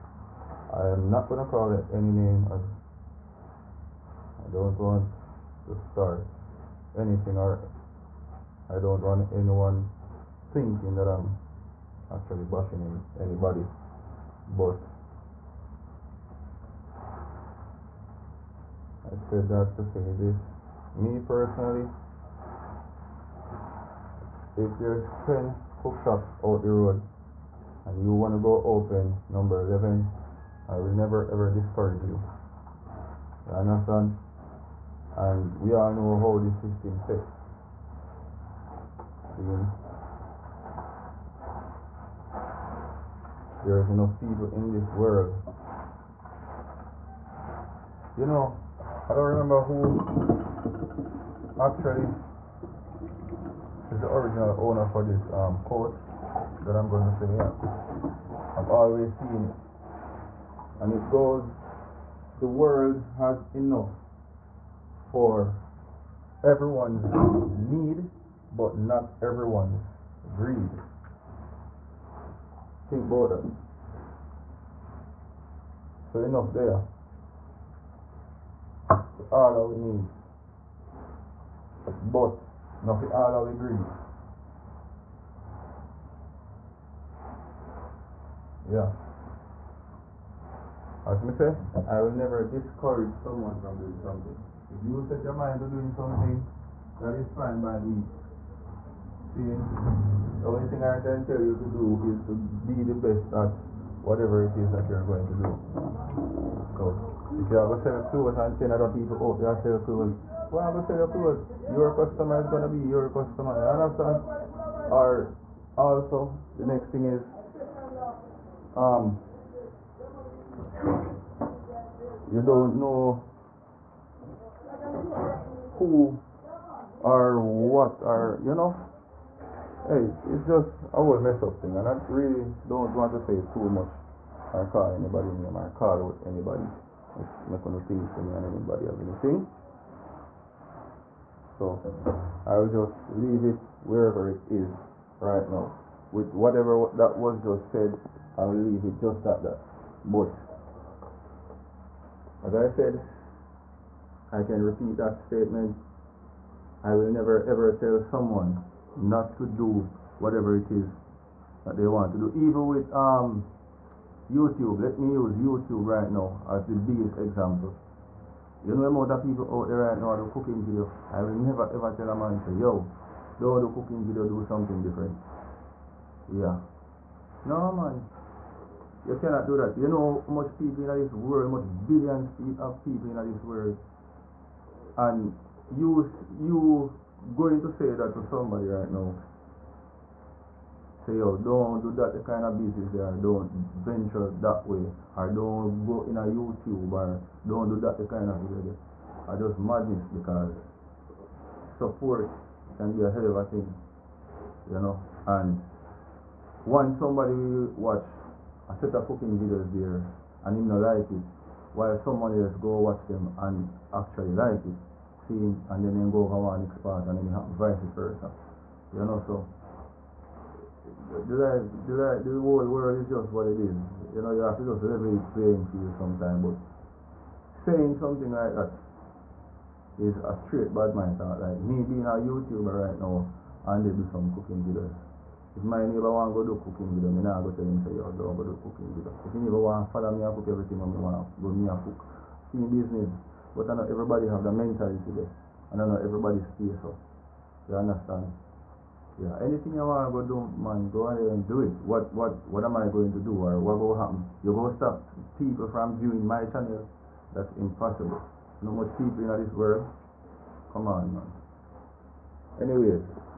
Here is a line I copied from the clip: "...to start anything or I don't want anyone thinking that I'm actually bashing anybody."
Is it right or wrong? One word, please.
right.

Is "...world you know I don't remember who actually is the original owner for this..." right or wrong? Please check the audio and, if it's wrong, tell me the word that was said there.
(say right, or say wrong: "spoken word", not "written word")
right.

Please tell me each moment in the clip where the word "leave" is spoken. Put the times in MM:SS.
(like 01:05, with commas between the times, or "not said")
02:23, 02:28.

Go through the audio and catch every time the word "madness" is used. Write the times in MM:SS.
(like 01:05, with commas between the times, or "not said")
03:19.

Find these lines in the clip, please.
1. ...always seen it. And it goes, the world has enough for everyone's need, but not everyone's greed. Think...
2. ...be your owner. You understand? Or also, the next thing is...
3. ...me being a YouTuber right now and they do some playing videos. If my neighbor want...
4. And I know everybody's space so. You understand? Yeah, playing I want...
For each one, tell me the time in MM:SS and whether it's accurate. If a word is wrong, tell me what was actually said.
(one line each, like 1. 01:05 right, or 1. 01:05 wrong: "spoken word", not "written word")
1. 00:58 right
2. 01:52 wrong: "customer", not "owner"
3. 03:51 wrong: "cooking", not "playing"
4. 04:05 wrong: "anything", not "playing".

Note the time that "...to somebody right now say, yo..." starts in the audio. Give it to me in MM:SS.
03:08.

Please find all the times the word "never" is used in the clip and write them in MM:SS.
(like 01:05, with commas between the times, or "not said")
00:30, 01:32, 02:37, 02:51.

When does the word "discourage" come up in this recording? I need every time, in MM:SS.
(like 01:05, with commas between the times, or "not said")
00:31, 01:32.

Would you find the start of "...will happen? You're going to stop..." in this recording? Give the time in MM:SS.
04:13.